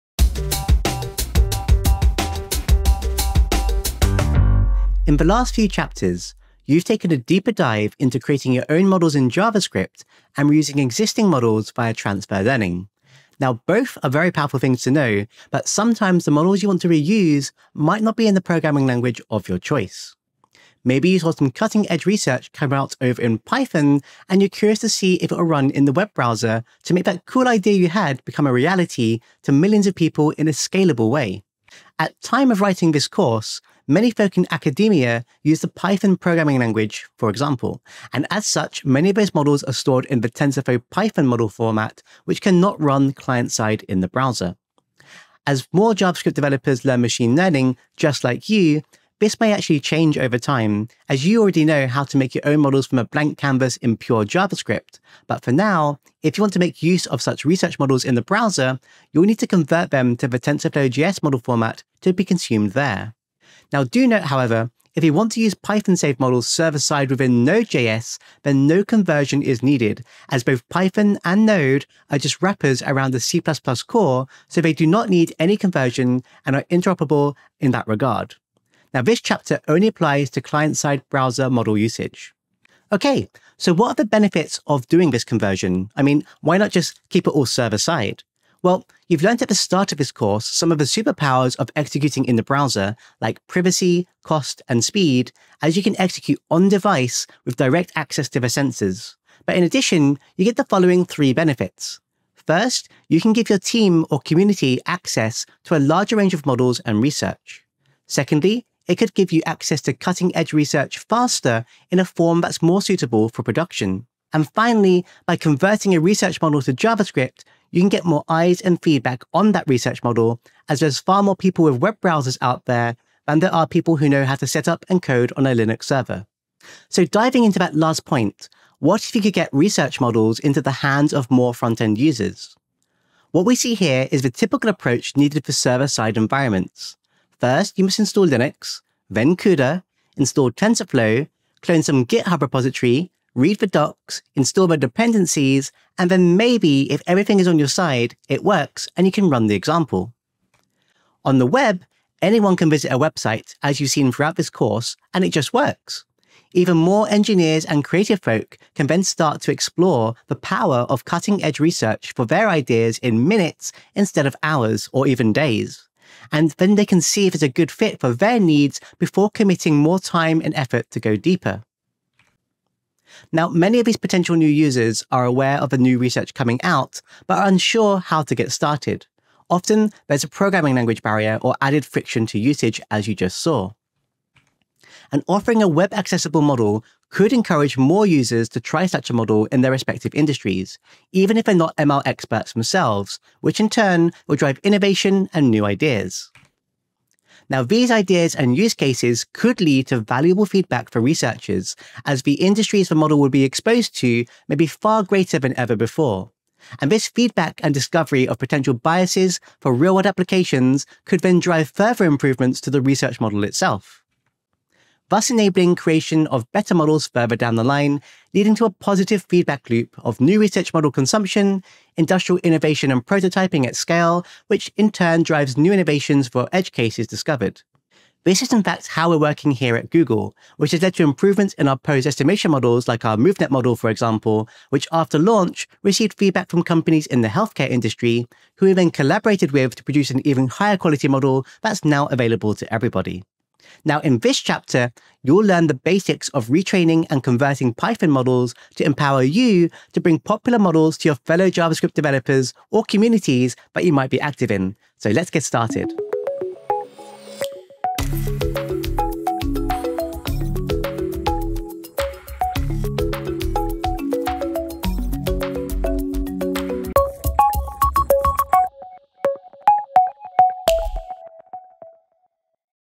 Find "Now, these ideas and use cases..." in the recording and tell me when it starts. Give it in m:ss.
3:17.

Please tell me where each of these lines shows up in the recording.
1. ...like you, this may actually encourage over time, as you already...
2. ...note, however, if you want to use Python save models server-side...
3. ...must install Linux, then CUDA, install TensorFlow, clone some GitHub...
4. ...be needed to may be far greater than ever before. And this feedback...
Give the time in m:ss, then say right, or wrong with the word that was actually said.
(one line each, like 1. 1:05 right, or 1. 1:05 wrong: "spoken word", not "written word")
1. 0:48 wrong: "change", not "encourage"
2. 1:04 right
3. 2:17 right
4. 3:23 wrong: "exposed", not "needed".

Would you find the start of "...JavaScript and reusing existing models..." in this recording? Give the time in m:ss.
0:09.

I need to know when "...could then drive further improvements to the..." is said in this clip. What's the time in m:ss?
3:31.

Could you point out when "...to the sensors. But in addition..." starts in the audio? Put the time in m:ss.
1:38.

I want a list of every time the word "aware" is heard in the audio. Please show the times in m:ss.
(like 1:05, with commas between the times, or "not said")
2:55.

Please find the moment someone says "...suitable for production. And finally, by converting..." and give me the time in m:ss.
1:52.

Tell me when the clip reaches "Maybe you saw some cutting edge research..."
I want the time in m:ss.
0:20.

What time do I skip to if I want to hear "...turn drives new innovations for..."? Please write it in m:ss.
3:44.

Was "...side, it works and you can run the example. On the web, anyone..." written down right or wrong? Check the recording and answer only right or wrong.
right.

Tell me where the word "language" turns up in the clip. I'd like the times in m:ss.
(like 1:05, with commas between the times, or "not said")
0:18, 0:36, 3:00.